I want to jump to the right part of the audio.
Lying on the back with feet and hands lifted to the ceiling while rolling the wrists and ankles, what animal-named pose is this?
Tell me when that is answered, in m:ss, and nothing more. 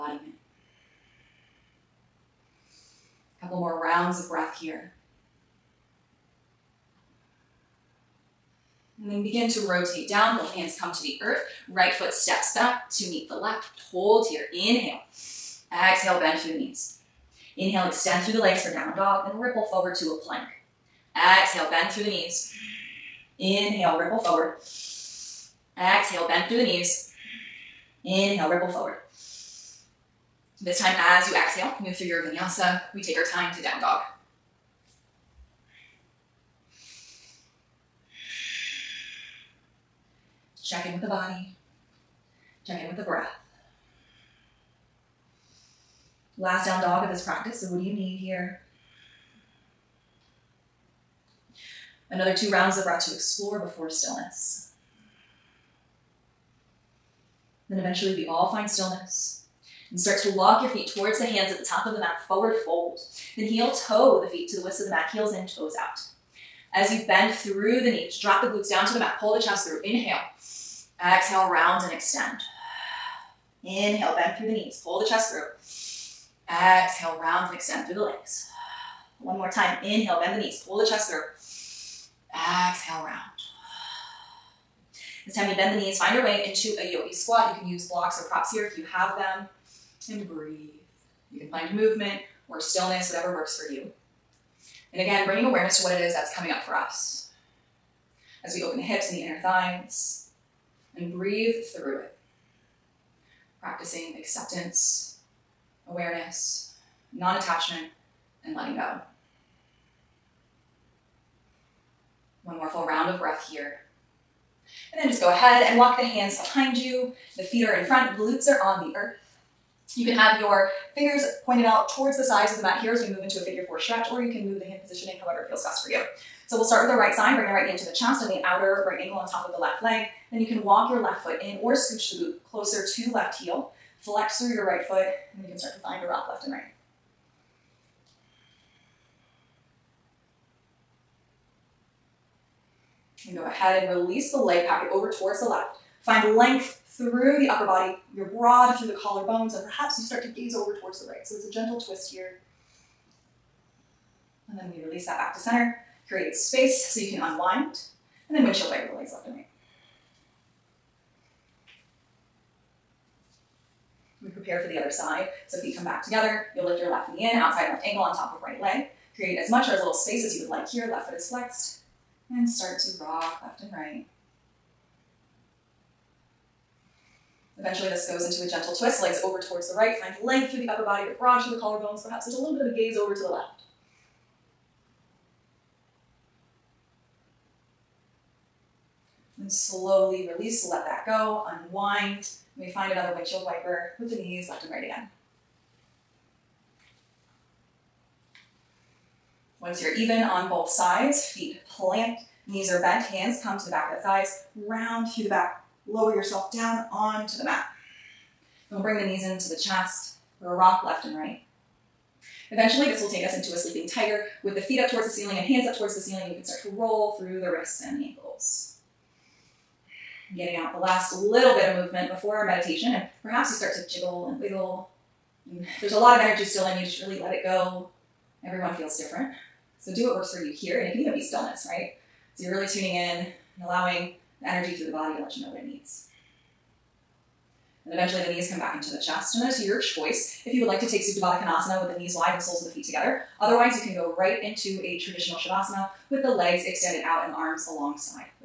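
3:33.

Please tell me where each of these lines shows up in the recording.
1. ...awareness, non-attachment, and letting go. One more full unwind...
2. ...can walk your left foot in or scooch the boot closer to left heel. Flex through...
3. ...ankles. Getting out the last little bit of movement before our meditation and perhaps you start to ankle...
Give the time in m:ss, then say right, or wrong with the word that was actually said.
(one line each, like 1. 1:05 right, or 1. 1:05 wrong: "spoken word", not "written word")
1. 1:45 wrong: "round", not "unwind"
2. 2:10 right
3. 3:38 wrong: "jiggle", not "ankle".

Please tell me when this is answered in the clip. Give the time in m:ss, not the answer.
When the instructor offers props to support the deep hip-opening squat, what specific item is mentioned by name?
1:27.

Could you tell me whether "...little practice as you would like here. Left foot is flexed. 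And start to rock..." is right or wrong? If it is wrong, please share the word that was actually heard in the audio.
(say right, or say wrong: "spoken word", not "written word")
wrong: "space", not "practice".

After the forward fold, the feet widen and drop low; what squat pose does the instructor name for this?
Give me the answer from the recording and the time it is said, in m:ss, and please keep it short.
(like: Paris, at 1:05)
yogi squat, at 1:26.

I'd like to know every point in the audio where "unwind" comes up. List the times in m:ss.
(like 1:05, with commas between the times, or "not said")
2:37, 3:11.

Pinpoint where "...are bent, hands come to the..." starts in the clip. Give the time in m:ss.
3:22.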